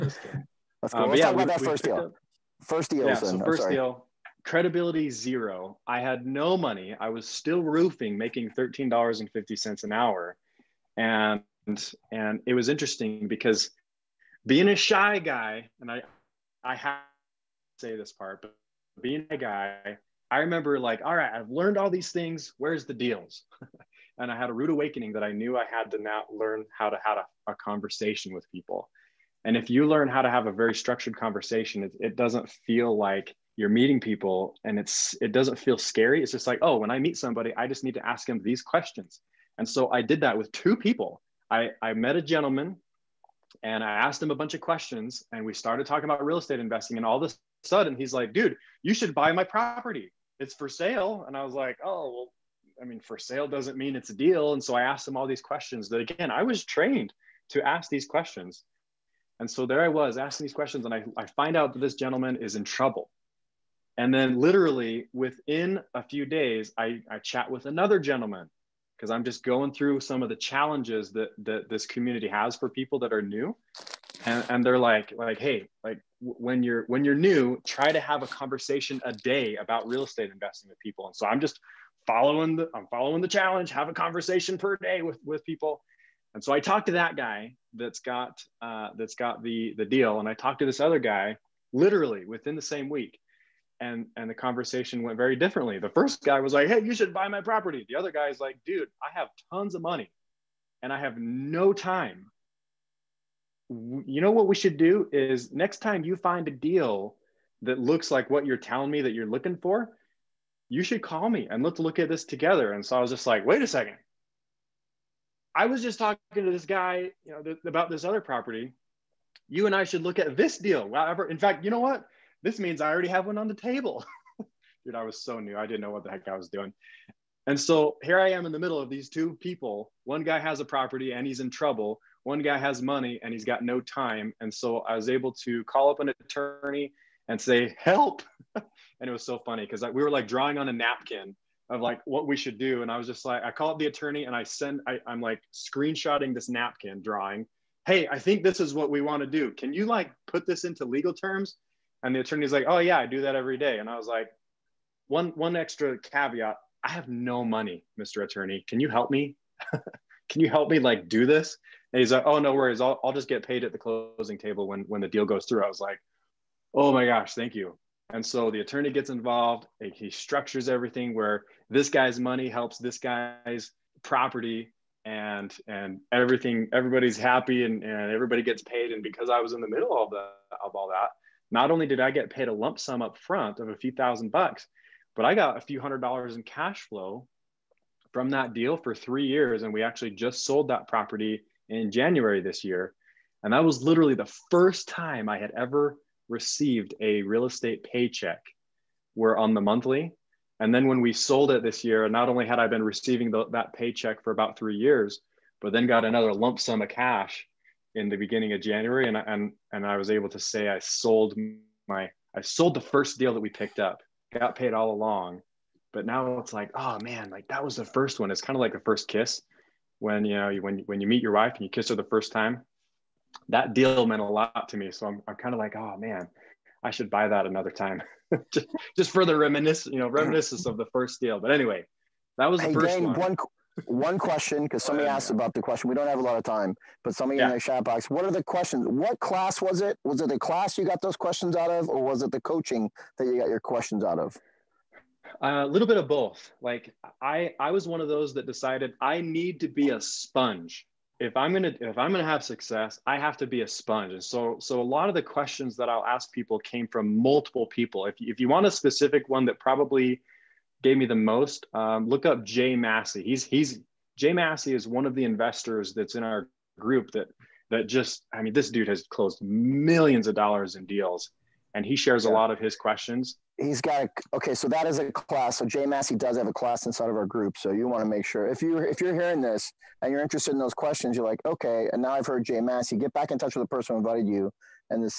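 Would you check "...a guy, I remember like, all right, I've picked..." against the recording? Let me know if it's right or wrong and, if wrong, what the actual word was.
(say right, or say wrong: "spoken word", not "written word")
wrong: "learned", not "picked".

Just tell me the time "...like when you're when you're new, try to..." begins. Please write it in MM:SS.
01:15.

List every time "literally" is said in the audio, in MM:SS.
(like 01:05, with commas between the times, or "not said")
01:04, 01:31, 03:13.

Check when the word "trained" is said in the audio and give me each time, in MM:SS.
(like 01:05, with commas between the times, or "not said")
00:56.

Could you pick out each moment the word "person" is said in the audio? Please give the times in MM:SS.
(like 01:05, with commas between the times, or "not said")
04:43.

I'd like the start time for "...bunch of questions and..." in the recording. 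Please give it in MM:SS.
00:44.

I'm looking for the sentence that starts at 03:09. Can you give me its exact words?
And we actually just sold that property in January this year.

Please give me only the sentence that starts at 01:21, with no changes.
And so I'm just following the I'm following the challenge, have a conversation per day with with people.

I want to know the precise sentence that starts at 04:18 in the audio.
If if you want a specific one that probably gave me the most.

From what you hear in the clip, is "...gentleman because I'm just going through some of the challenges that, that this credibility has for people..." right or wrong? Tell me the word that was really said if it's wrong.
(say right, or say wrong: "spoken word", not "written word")
wrong: "community", not "credibility".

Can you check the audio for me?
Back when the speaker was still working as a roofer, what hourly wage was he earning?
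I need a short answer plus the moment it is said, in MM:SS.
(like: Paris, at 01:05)
$13.50, at 00:08.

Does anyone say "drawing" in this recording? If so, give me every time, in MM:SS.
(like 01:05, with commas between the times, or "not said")
02:20, 02:27.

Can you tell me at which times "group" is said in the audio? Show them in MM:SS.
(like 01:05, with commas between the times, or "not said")
04:26, 04:37.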